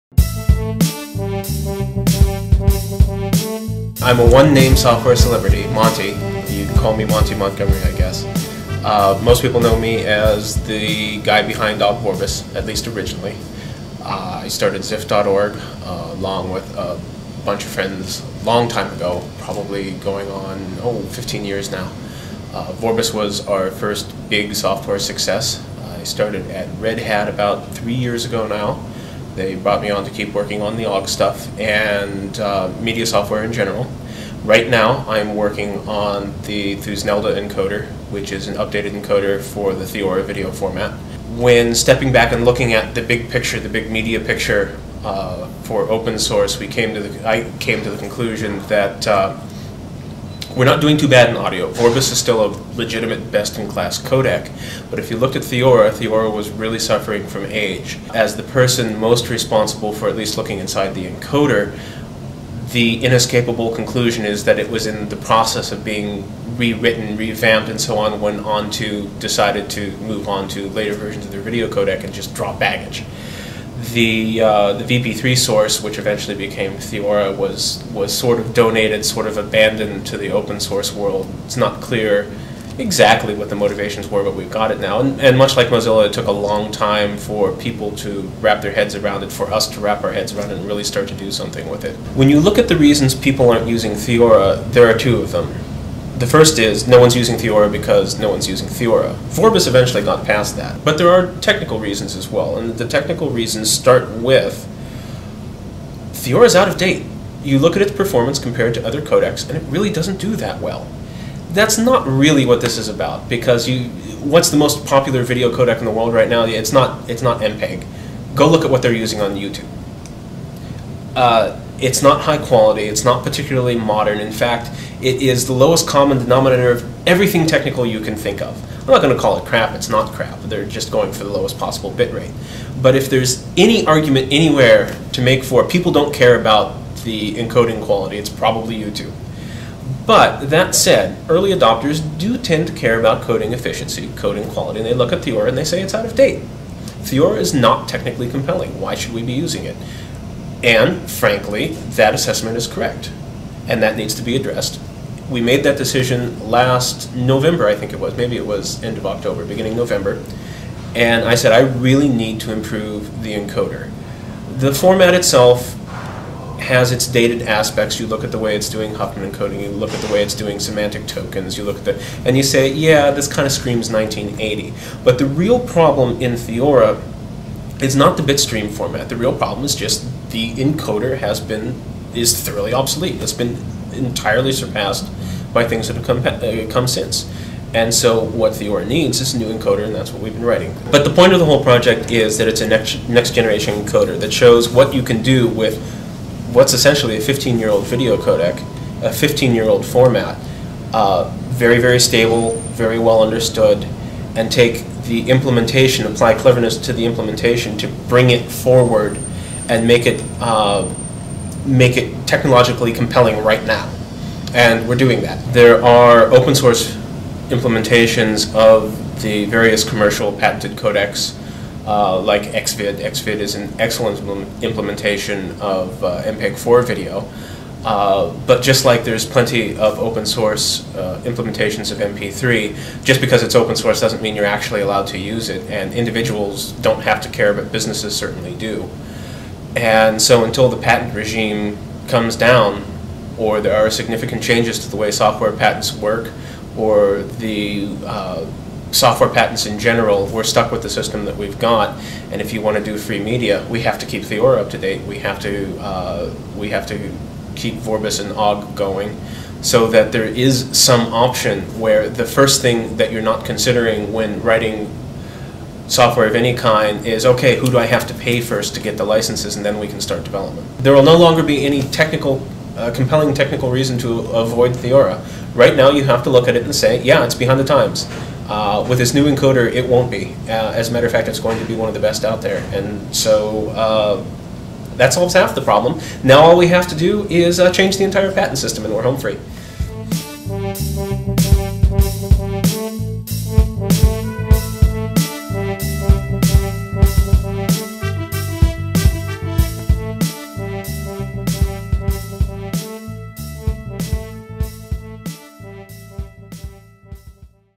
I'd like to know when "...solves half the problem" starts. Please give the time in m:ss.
4:45.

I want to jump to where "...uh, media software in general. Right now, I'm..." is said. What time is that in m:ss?
0:32.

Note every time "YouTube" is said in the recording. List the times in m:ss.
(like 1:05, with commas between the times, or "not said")
1:59, 2:18.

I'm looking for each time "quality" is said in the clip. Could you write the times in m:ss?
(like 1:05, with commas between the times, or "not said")
2:02, 2:17, 2:24.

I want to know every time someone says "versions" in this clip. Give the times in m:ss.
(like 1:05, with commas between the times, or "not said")
1:10.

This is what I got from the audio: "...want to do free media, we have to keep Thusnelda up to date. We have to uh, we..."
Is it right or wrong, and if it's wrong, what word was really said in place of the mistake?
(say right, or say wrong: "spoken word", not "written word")
wrong: "Theora", not "Thusnelda".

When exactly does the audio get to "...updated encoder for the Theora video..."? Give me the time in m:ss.
0:38.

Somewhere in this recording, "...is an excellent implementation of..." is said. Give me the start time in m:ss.
3:43.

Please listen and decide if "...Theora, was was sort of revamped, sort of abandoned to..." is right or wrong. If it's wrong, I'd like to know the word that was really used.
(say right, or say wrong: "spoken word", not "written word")
wrong: "donated", not "revamped".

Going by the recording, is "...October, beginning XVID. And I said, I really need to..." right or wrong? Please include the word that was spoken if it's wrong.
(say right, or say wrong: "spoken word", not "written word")
wrong: "November", not "XVID".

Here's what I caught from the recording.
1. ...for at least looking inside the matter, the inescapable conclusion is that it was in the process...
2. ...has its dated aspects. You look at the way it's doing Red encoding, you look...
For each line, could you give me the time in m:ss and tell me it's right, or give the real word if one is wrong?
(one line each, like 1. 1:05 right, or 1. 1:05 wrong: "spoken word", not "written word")
1. 0:59 wrong: "encoder", not "matter"
2. 2:46 wrong: "Huffman", not "Red".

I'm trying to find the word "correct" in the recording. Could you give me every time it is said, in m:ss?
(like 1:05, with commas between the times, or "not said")
2:32.